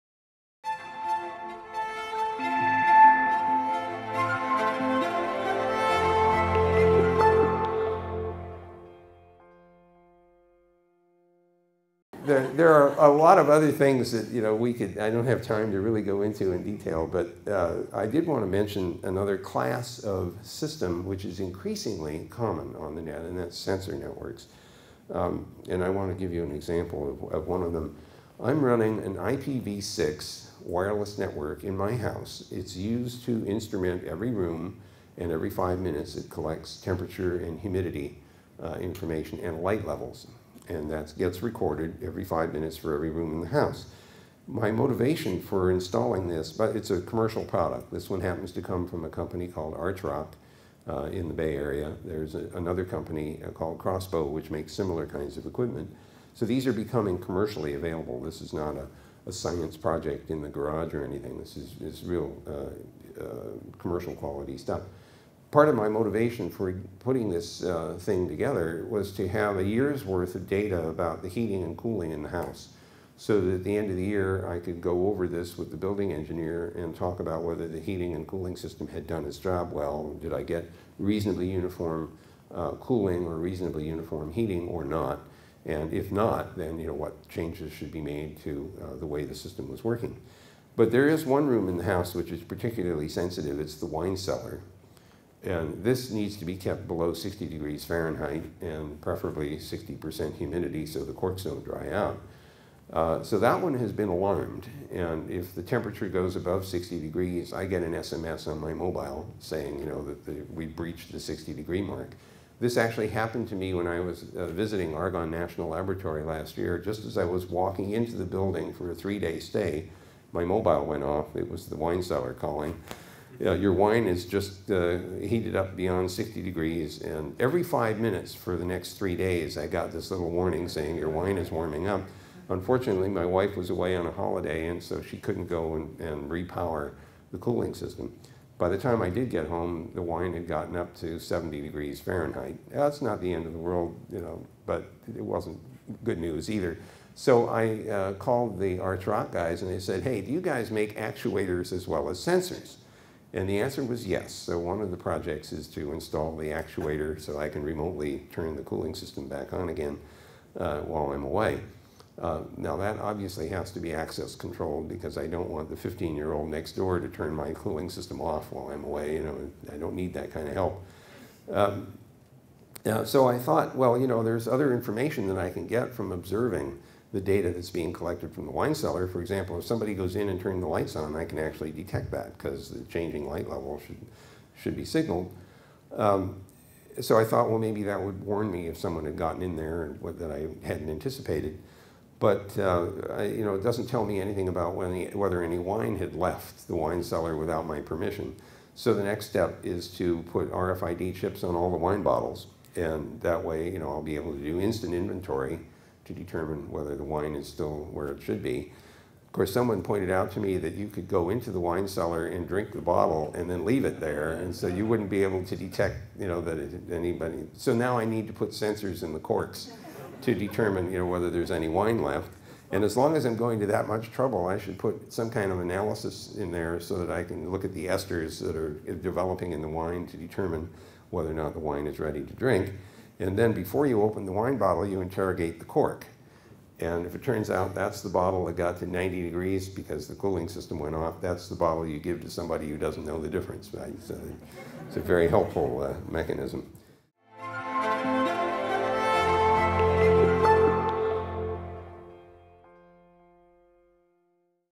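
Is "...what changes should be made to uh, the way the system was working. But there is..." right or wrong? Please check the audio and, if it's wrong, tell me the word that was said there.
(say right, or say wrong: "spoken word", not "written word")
right.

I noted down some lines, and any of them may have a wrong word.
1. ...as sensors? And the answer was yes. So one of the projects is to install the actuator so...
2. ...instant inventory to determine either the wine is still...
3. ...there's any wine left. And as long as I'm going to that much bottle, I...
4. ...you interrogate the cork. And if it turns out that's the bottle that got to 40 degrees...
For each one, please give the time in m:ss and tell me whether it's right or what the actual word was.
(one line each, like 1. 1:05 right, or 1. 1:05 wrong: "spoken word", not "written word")
1. 2:32 right
2. 3:24 wrong: "whether", not "either"
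3. 3:41 wrong: "trouble", not "bottle"
4. 3:54 wrong: "90", not "40".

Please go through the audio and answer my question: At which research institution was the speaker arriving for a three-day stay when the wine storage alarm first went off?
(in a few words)
Argonne National Laboratory.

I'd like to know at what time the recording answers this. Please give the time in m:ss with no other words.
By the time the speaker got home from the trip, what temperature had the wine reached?
2:21.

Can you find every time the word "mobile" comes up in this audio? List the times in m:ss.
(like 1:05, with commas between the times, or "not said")
1:48, 2:00.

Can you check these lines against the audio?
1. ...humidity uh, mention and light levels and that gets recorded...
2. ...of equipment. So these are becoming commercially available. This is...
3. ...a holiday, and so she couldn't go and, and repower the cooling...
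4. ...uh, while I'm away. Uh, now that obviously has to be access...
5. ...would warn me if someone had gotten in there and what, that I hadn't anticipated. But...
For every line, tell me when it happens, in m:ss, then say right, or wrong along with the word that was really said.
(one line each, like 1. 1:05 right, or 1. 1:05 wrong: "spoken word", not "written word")
1. 0:37 wrong: "information", not "mention"
2. 0:55 right
3. 2:14 right
4. 2:40 right
5. 3:08 right.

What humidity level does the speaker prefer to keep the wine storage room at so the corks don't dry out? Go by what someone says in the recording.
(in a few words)
60%.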